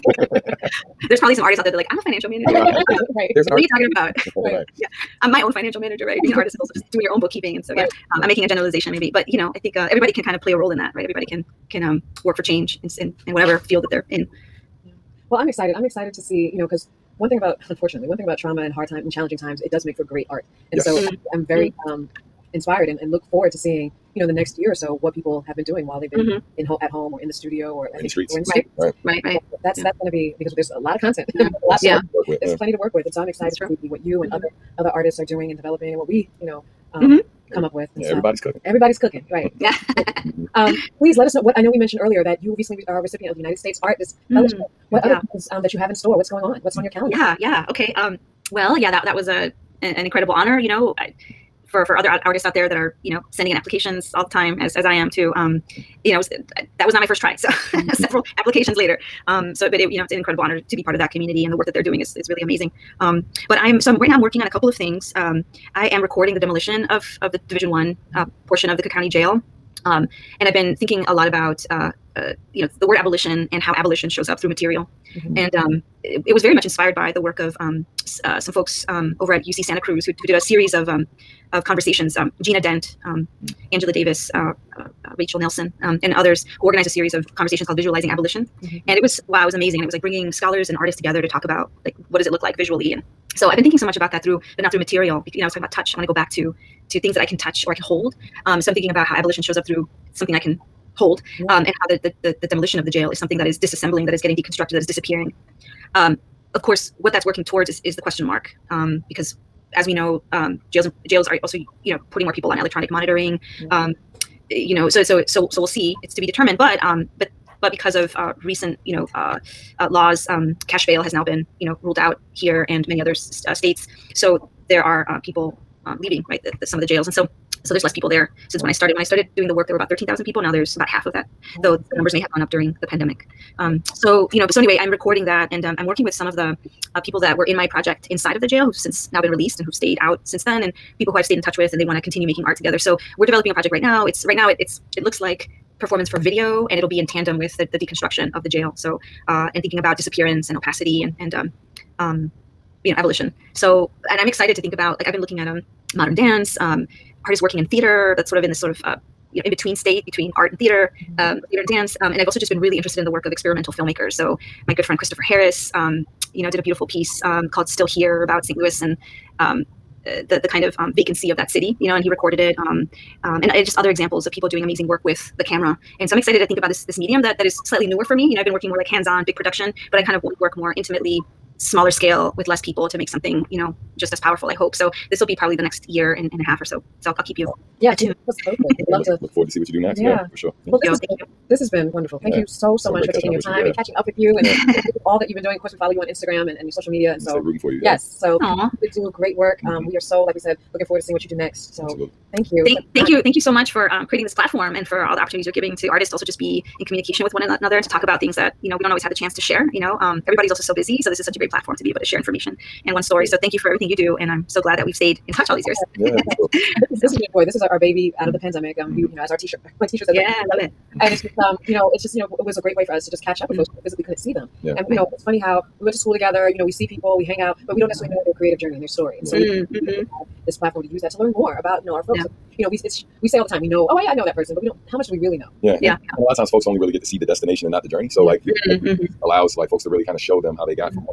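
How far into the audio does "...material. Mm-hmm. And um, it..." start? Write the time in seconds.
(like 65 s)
74 s.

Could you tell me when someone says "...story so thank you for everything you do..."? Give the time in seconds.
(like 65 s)
213 s.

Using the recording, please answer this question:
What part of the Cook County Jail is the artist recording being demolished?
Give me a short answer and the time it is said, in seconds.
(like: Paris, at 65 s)
Division One, at 67 s.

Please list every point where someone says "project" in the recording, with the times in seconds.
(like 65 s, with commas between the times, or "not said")
137 s, 143 s.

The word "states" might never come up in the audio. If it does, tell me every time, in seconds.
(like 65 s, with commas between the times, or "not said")
43 s, 123 s, 159 s.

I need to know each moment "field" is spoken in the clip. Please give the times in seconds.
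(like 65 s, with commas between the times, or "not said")
13 s.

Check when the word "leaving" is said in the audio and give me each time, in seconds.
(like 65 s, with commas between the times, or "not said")
125 s.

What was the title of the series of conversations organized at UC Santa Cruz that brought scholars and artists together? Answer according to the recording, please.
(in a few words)
Visualizing Abolition.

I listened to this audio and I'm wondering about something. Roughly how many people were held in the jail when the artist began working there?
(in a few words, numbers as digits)
13,000.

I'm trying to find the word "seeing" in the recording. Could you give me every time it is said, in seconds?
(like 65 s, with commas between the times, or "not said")
23 s, 201 s.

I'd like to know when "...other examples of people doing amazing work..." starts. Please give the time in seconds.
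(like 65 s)
173 s.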